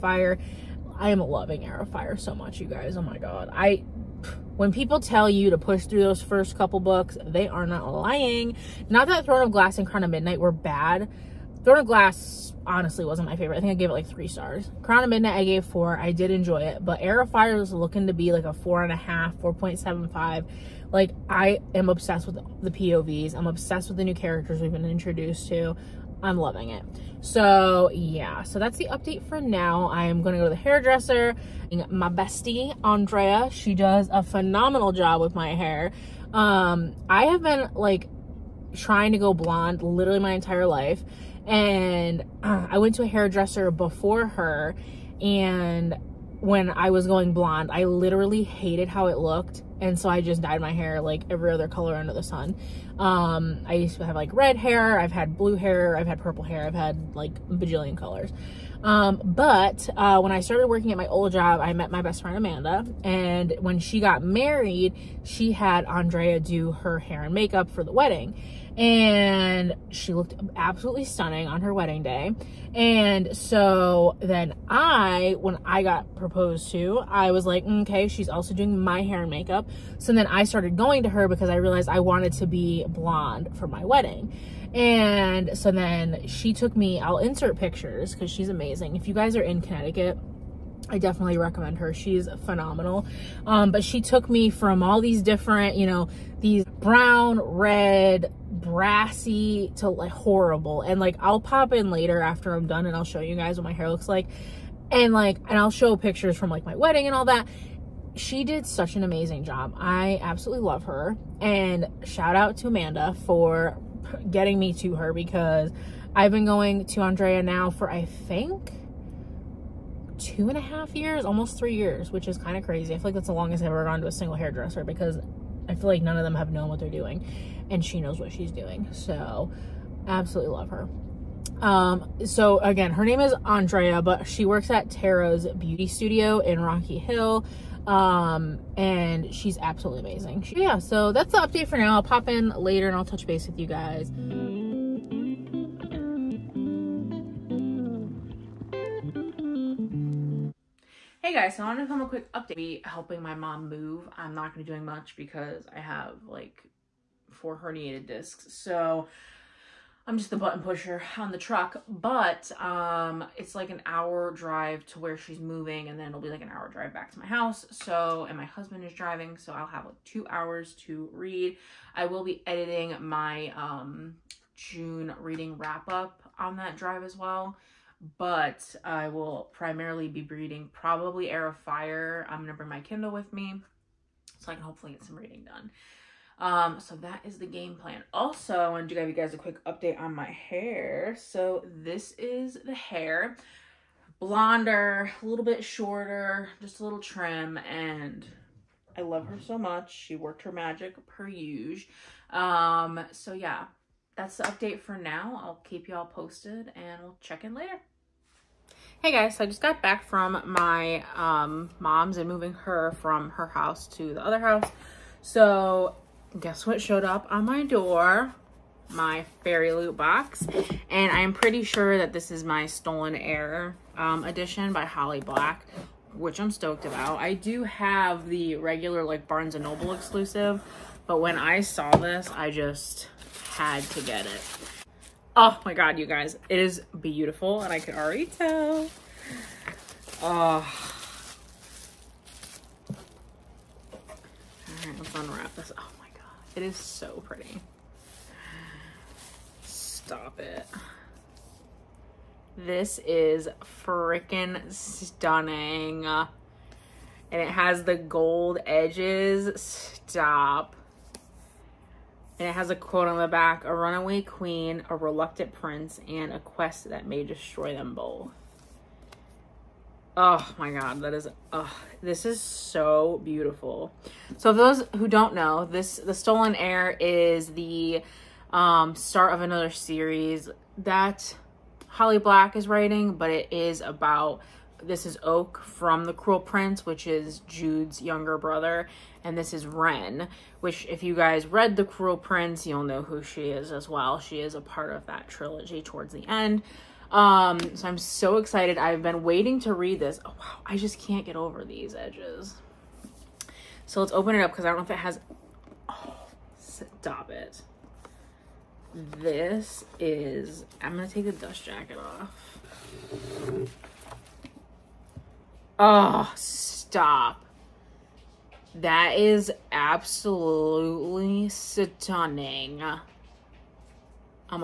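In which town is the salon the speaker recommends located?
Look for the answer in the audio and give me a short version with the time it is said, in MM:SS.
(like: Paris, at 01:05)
Rocky Hill, at 02:16.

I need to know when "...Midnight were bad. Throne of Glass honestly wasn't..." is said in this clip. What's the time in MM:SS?
00:10.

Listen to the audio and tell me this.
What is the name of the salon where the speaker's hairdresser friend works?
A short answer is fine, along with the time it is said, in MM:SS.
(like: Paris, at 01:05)
Tarot's beauty studio, at 02:14.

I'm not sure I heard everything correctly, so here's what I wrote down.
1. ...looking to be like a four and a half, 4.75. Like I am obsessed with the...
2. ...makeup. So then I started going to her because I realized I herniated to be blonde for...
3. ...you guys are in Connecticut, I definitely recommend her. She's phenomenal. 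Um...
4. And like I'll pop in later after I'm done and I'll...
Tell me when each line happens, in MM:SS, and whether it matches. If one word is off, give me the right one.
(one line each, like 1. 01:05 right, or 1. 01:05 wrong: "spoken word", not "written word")
1. 00:17 right
2. 01:19 wrong: "wanted", not "herniated"
3. 01:29 right
4. 01:40 right.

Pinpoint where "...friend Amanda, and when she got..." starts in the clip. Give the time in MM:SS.
01:02.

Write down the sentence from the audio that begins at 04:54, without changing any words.
She is a part of that trilogy towards the end.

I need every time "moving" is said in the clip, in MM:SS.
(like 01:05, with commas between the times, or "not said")
02:45, 03:32.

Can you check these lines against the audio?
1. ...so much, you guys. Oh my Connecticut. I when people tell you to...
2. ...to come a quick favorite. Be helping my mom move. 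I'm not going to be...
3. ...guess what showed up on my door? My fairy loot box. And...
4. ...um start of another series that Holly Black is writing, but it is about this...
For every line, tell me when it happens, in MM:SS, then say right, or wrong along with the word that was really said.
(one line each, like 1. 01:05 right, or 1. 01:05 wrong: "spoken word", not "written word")
1. 00:02 wrong: "God", not "Connecticut"
2. 02:31 wrong: "update", not "favorite"
3. 03:36 right
4. 04:38 right.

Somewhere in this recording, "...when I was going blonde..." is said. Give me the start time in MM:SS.
00:46.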